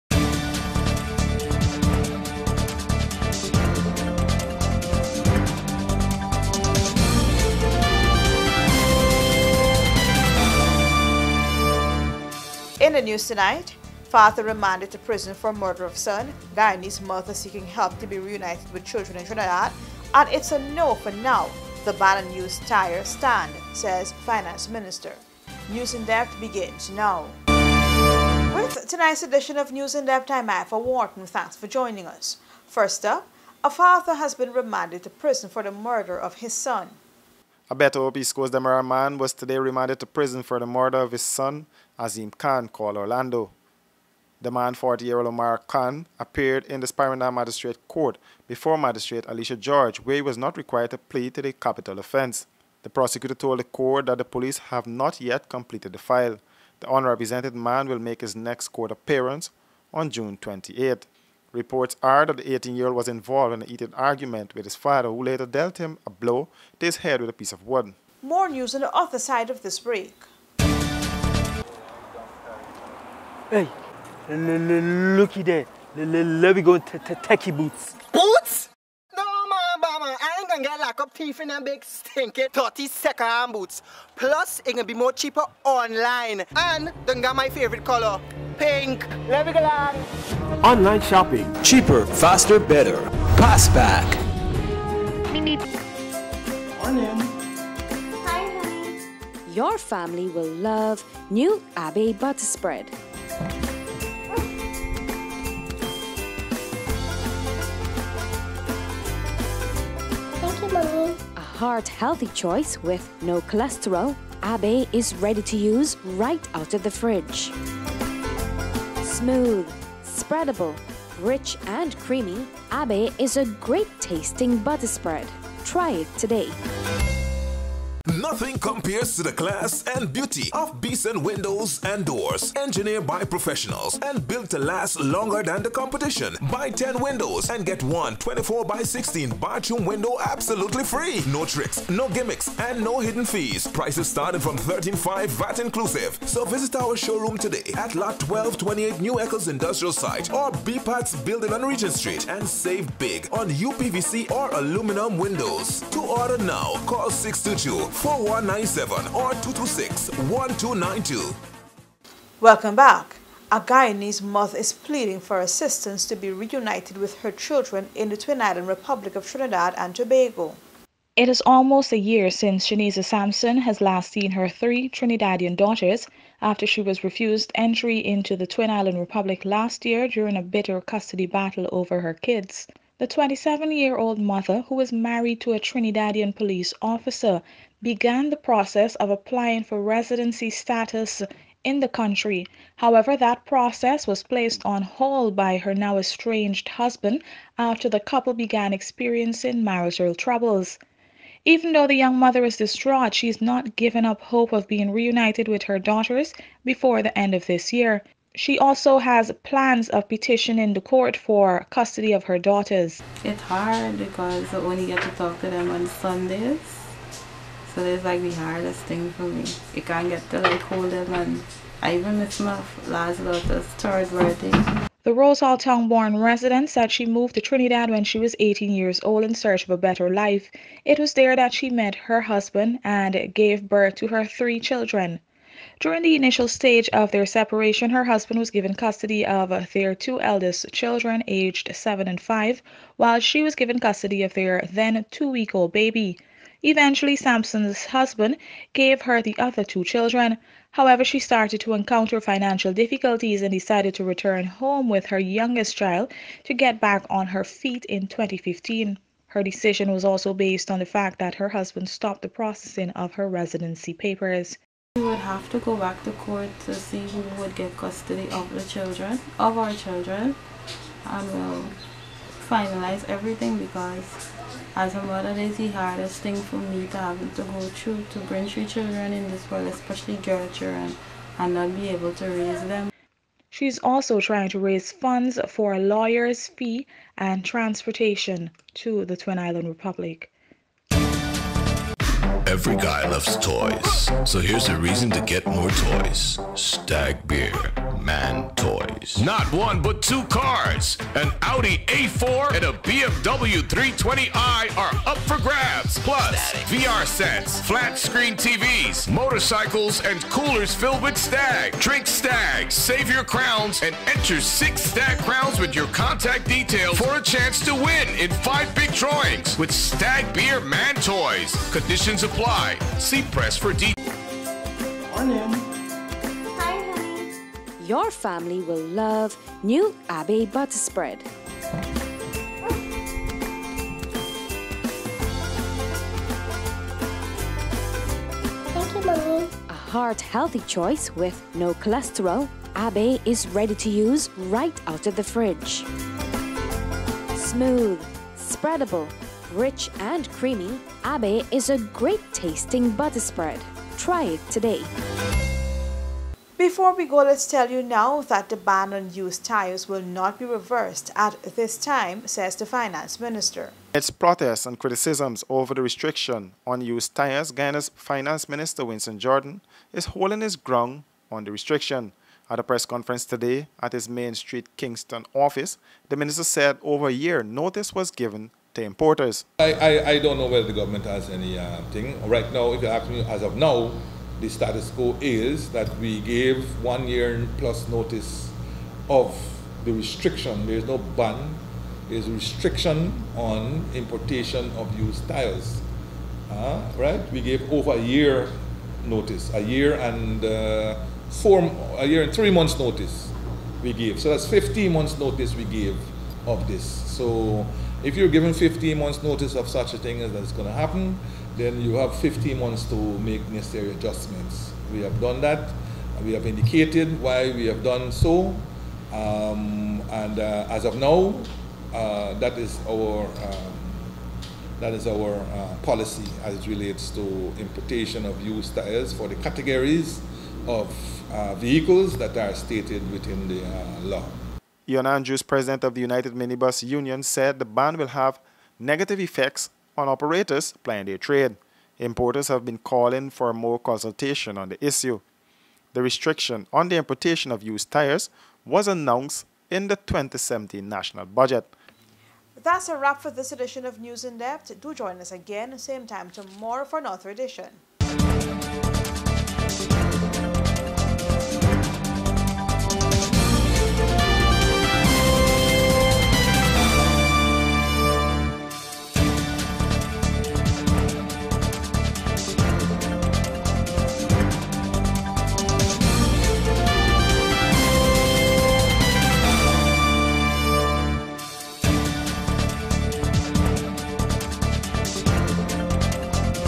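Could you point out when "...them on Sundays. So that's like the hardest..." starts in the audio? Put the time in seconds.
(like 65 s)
215 s.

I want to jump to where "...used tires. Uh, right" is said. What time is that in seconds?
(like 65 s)
394 s.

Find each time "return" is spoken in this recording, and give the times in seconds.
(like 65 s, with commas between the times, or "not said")
254 s.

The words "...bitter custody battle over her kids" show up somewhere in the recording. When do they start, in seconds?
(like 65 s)
180 s.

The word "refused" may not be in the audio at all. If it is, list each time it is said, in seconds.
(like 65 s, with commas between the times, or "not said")
177 s.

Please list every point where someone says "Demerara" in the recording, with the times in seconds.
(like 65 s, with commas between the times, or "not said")
38 s.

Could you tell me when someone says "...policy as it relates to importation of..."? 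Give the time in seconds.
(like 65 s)
425 s.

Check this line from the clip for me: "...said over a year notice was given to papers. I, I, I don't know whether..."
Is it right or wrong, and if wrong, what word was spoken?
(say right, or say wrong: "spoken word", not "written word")
wrong: "importers", not "papers".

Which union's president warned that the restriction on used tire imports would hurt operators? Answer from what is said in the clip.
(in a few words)
United Minibus Union.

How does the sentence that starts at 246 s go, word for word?
Eventually, Sampson's husband gave her the other two children.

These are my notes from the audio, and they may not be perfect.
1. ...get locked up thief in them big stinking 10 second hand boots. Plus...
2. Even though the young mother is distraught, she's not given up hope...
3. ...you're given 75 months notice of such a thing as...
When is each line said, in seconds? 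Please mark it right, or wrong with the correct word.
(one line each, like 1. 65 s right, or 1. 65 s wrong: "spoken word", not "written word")
1. 80 s wrong: "30", not "10"
2. 201 s right
3. 408 s wrong: "15", not "75".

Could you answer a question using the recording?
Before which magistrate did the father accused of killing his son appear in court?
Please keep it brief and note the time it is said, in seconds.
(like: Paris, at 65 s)
Alicia George, at 49 s.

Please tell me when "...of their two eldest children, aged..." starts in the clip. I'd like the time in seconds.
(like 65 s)
239 s.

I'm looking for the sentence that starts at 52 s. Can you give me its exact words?
The prosecutor told the court that the police have not yet completed the file.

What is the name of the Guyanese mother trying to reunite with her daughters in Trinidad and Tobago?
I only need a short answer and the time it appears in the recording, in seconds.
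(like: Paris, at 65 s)
Shaniza Sampson, at 172 s.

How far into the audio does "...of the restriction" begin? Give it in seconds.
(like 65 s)
389 s.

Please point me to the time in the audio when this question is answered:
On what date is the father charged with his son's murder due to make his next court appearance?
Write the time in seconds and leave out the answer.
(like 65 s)
60 s.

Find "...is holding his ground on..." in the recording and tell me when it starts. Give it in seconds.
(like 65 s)
369 s.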